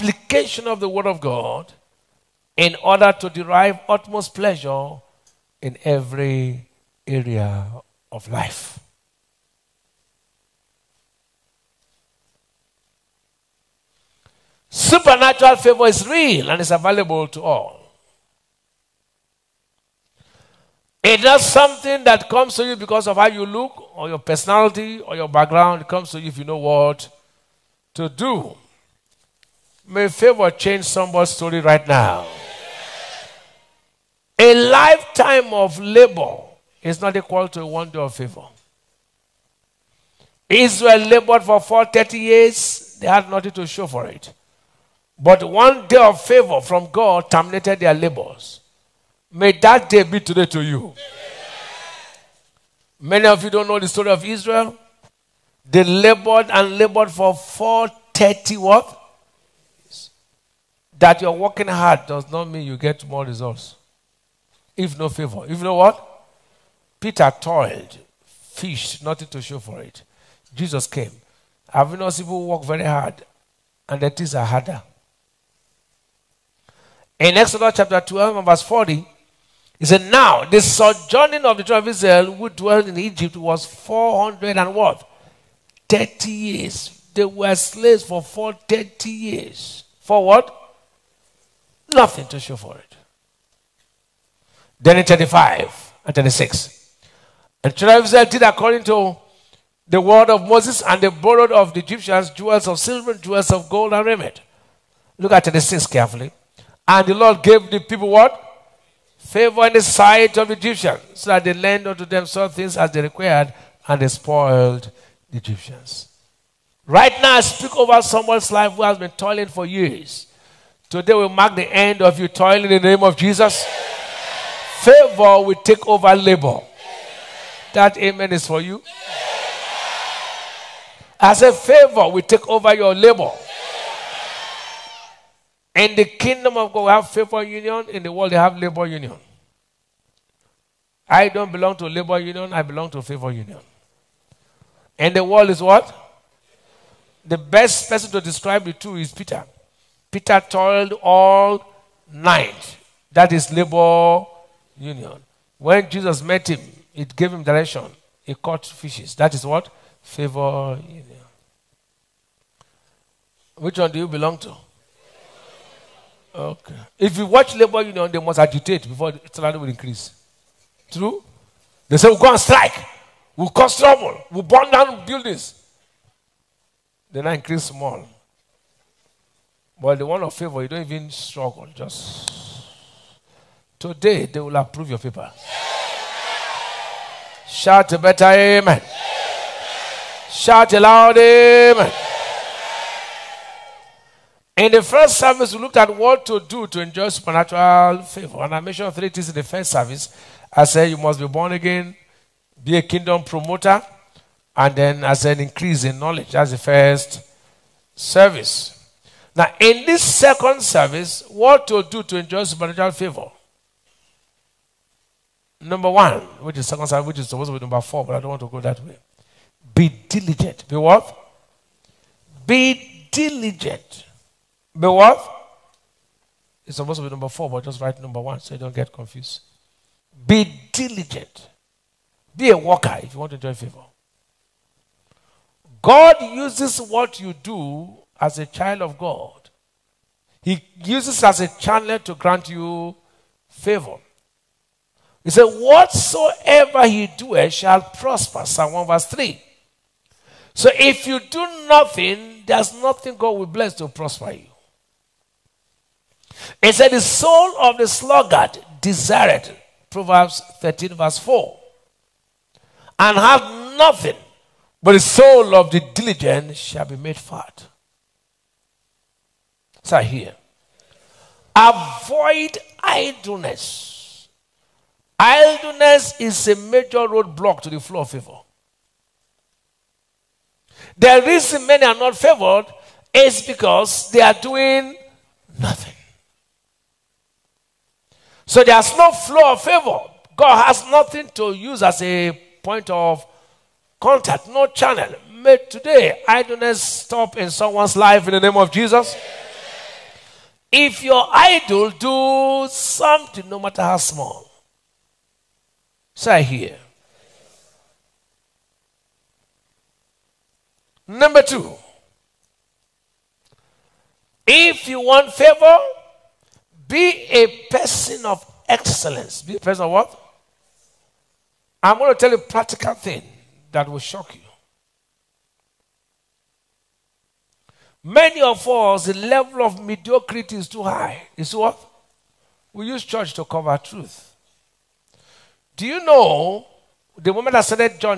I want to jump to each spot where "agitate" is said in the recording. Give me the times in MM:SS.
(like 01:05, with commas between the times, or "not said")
02:48.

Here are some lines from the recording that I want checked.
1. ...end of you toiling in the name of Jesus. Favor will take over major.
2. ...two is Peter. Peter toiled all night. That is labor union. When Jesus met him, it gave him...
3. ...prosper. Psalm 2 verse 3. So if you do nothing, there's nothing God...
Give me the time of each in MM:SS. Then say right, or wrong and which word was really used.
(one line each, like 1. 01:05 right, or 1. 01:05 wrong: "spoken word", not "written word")
1. 02:01 wrong: "labor", not "major"
2. 02:28 right
3. 04:07 wrong: "1", not "2".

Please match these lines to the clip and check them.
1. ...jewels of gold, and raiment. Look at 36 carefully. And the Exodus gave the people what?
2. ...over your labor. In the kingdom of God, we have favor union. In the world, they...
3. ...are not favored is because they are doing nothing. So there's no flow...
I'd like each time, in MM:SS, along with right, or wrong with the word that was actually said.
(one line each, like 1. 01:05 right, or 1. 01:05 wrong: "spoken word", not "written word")
1. 01:43 wrong: "Lord", not "Exodus"
2. 02:12 right
3. 04:41 right.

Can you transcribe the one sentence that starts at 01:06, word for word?
Peter toiled, fished, nothing to show for it.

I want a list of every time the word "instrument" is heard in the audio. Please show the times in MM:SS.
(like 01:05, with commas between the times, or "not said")
not said.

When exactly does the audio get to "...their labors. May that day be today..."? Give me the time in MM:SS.
00:47.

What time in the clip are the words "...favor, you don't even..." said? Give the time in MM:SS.
03:00.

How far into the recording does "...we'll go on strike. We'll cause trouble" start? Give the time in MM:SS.
02:52.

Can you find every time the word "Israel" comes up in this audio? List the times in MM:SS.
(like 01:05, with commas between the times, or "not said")
00:40, 00:54, 01:21, 01:38.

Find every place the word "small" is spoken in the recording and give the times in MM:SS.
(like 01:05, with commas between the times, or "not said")
02:57, 05:03.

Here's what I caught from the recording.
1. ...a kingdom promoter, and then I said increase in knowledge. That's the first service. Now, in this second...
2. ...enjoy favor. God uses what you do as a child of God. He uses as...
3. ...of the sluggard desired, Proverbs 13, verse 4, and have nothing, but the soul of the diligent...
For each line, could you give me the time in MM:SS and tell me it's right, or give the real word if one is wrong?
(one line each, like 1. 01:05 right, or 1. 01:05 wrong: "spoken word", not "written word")
1. 03:22 right
2. 03:53 right
3. 04:17 right.